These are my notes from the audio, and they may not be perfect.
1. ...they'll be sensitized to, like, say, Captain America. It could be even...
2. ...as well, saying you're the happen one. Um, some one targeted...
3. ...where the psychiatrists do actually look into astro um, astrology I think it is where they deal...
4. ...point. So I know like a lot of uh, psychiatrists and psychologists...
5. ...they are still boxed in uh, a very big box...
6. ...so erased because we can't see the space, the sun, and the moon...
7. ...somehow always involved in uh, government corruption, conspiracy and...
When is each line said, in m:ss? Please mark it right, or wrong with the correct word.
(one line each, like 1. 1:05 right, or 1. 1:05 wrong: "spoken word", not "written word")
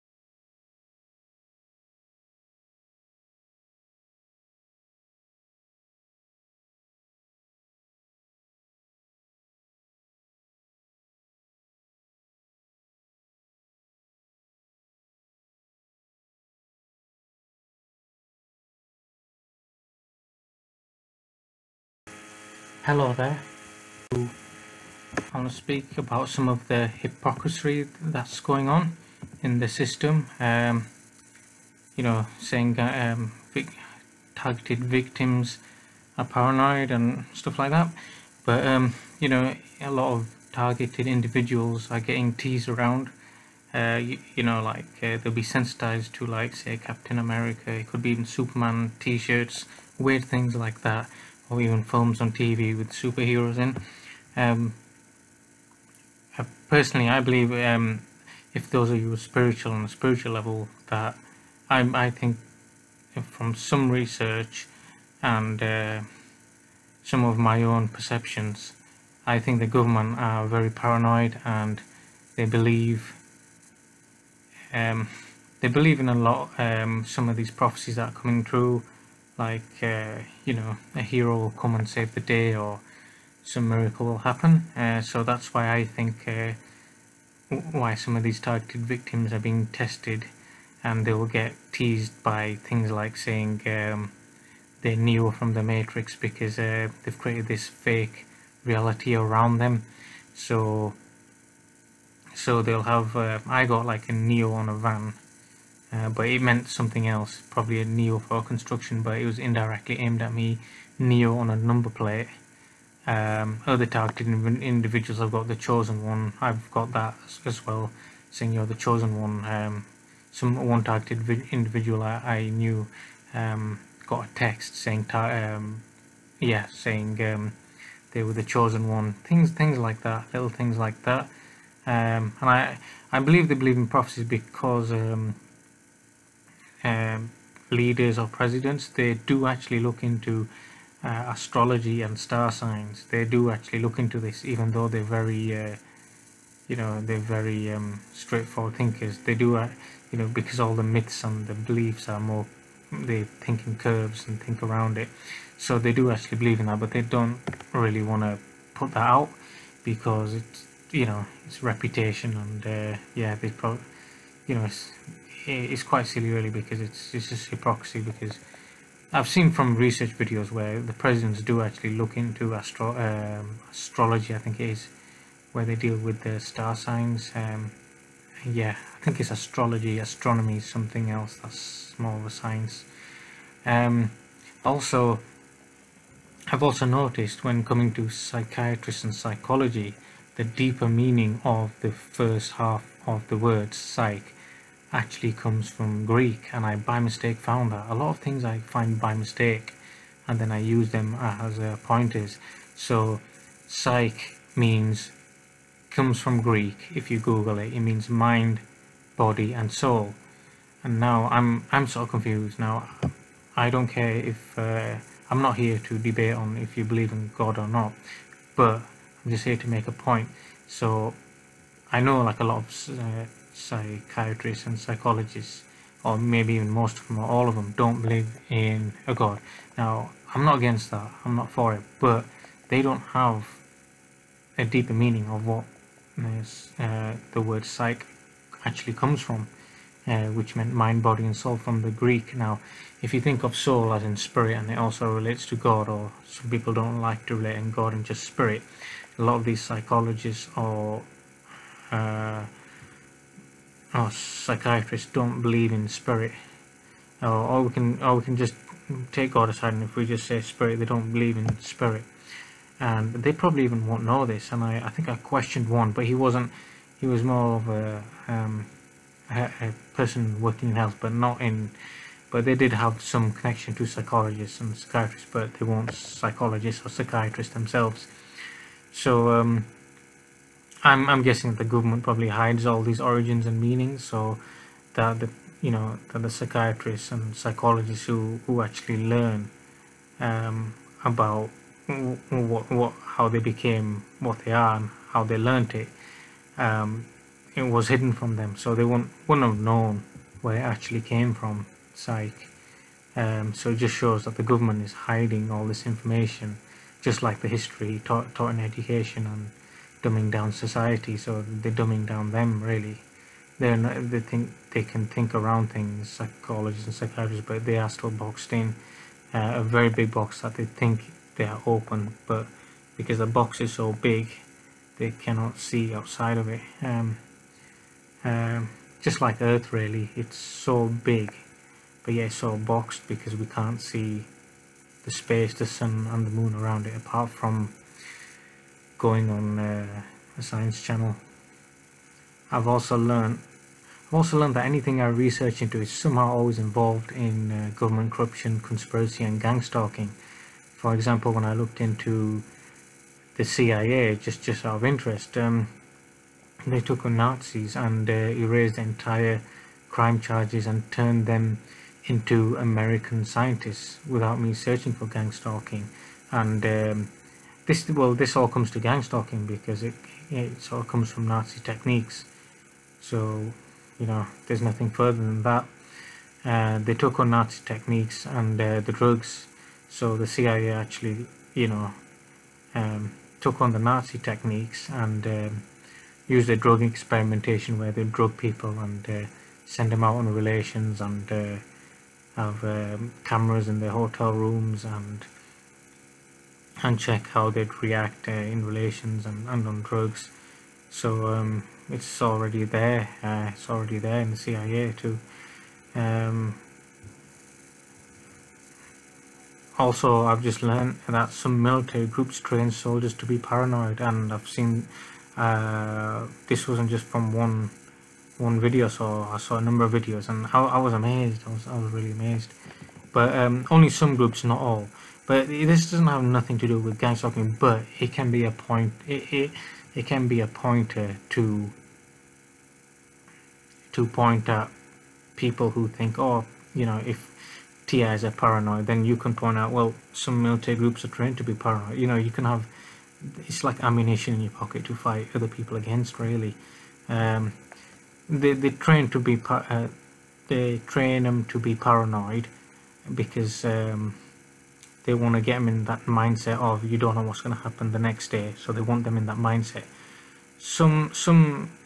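1. 0:45 right
2. 1:57 wrong: "chosen", not "happen"
3. 2:50 wrong: "presidents", not "psychiatrists"
4. 3:39 right
5. 5:17 right
6. 5:32 wrong: "boxed", not "erased"
7. 5:45 right.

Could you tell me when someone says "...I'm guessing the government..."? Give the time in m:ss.
4:41.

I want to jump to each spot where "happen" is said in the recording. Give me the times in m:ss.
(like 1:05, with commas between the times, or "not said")
1:24, 7:37.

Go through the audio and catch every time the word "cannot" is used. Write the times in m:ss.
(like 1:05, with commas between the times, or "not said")
5:25.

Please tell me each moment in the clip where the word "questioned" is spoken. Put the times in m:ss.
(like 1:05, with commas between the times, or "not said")
4:25.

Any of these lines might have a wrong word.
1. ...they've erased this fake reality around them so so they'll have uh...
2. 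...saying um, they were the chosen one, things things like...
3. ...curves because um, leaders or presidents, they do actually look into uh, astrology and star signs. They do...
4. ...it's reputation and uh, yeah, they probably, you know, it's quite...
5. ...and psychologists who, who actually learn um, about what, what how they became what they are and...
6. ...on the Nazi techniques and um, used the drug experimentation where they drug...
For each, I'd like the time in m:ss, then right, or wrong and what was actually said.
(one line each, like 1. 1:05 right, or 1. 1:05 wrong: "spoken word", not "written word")
1. 1:37 wrong: "created", not "erased"
2. 2:06 right
3. 2:13 wrong: "prophecies", not "curves"
4. 2:41 right
5. 4:47 right
6. 6:23 right.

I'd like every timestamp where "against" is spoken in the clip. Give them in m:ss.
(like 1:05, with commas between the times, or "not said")
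3:50, 7:25.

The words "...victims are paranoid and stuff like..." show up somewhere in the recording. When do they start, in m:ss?
0:34.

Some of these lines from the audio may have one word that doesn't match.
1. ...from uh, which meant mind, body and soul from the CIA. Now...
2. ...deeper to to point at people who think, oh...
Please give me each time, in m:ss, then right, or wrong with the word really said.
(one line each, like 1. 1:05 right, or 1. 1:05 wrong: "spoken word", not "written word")
1. 3:59 wrong: "Greek", not "CIA"
2. 7:10 wrong: "pointer", not "deeper".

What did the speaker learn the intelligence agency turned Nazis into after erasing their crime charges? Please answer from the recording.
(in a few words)
American scientists.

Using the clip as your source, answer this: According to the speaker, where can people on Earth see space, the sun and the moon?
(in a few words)
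science channel.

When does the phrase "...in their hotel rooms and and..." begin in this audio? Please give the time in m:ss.
6:33.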